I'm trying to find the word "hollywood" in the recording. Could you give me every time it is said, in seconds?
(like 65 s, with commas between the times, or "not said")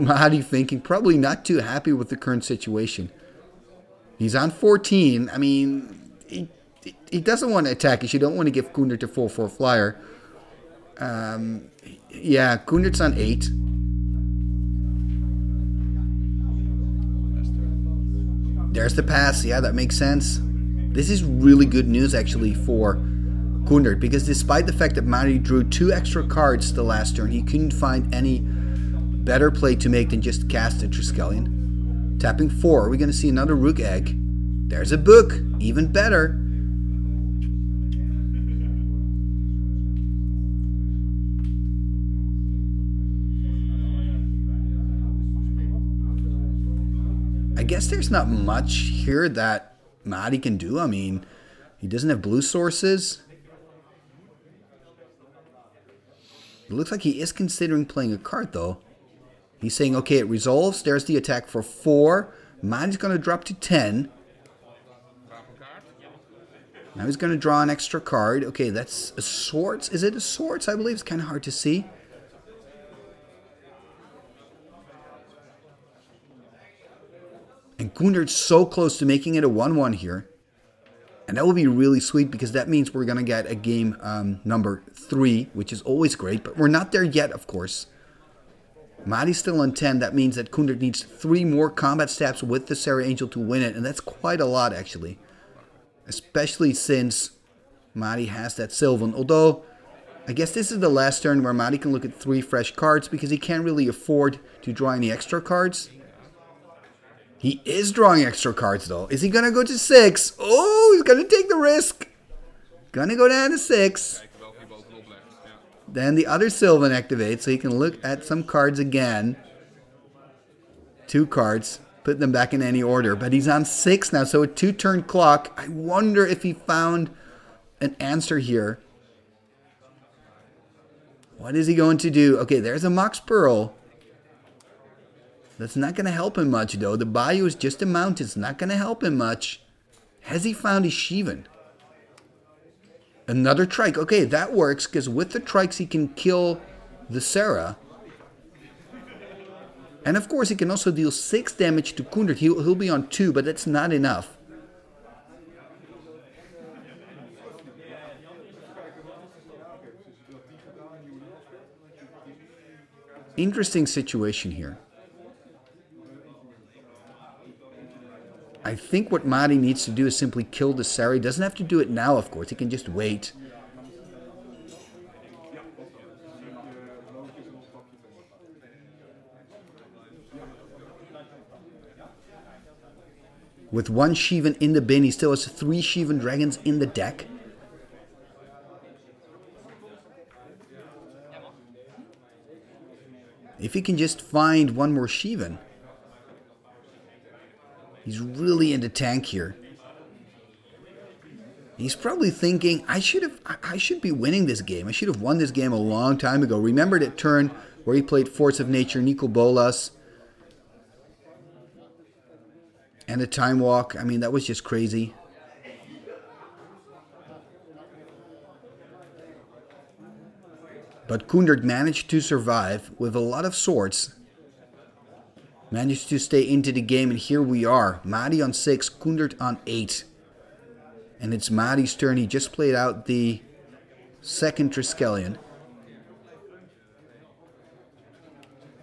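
not said.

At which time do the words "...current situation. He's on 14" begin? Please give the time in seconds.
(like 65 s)
2 s.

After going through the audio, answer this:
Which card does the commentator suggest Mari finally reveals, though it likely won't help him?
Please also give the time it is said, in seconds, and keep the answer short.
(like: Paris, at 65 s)
Mox Pearl, at 132 s.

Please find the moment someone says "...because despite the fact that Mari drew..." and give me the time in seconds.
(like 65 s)
23 s.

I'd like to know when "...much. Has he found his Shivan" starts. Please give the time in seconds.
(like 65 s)
139 s.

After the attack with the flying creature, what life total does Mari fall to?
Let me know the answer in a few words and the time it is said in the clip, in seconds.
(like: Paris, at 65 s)
10, at 63 s.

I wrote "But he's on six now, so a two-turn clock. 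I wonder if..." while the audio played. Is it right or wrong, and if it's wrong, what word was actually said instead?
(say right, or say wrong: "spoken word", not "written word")
right.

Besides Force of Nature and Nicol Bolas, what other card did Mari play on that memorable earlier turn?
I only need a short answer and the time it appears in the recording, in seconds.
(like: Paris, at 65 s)
Time Walk, at 213 s.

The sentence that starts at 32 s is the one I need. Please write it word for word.
Tapping four, are we going to see another Rukh Egg?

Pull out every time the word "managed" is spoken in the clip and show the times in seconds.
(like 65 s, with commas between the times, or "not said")
221 s, 225 s.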